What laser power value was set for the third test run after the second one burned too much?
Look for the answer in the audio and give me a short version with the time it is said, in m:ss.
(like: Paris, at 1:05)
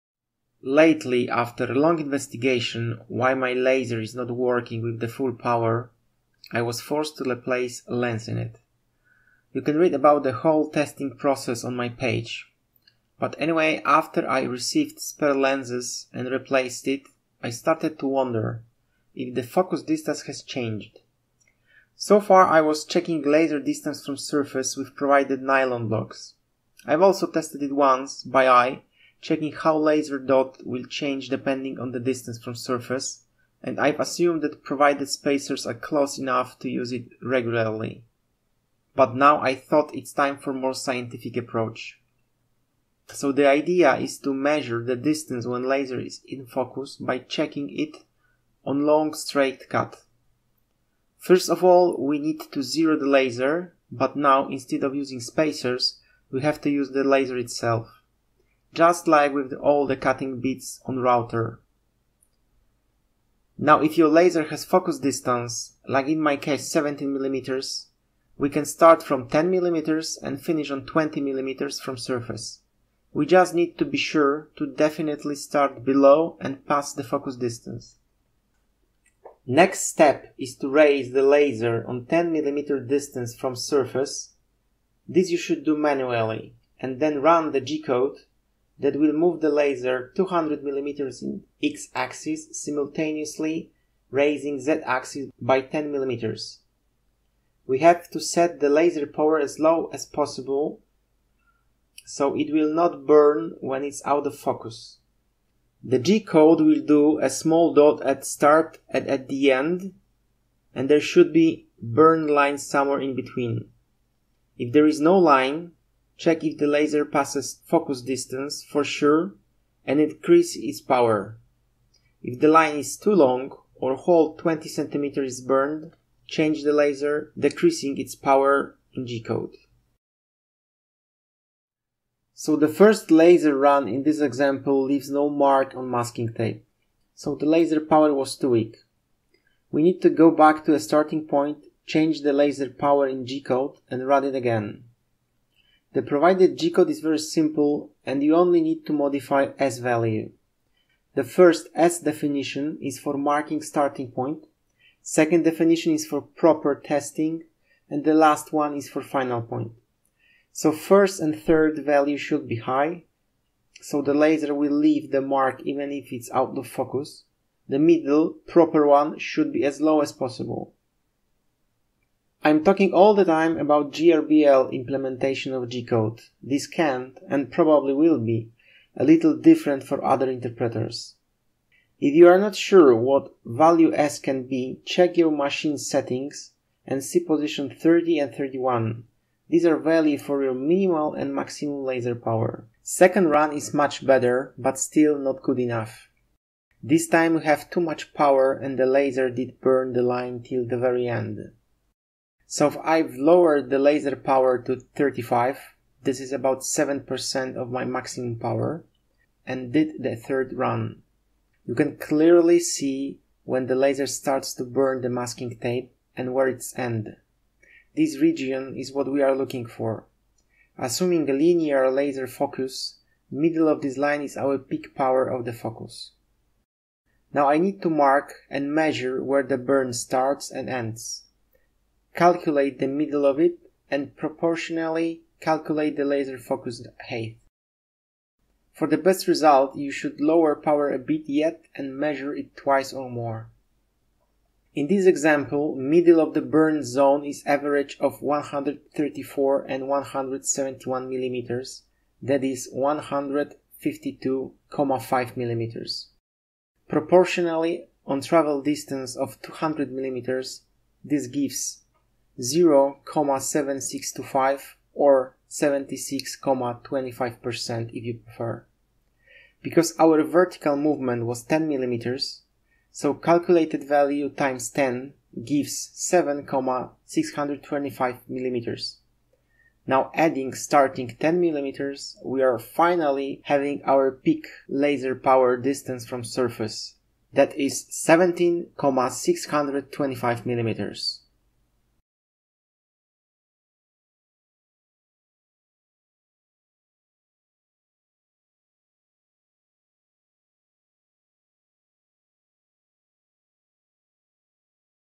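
35, at 3:24.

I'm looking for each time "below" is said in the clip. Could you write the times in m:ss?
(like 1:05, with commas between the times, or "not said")
1:15.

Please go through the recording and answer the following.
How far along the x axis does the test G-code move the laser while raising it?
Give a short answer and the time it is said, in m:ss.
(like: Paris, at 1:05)
200 mm, at 1:30.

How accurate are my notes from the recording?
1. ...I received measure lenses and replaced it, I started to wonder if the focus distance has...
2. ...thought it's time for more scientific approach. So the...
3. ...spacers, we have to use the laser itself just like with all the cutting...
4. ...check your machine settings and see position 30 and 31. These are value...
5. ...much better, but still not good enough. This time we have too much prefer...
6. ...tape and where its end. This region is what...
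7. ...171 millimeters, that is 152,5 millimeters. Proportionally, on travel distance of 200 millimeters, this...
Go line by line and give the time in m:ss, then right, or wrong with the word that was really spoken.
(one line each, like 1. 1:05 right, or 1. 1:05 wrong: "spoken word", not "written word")
1. 0:14 wrong: "spare", not "measure"
2. 0:39 right
3. 0:55 right
4. 3:04 right
5. 3:13 wrong: "power", not "prefer"
6. 3:35 right
7. 4:09 right.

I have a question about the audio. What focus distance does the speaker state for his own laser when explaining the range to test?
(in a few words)
17mm.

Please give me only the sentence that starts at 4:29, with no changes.
Because our vertical movement was 10 millimeters, so calculated value times 10 gives 7,625 millimeters.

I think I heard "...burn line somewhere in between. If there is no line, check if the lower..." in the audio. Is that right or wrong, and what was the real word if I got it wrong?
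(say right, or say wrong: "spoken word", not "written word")
wrong: "laser", not "lower".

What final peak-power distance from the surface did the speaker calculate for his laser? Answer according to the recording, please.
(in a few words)
17.625 mm.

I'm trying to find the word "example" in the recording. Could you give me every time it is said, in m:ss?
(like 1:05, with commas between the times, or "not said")
2:14, 4:05.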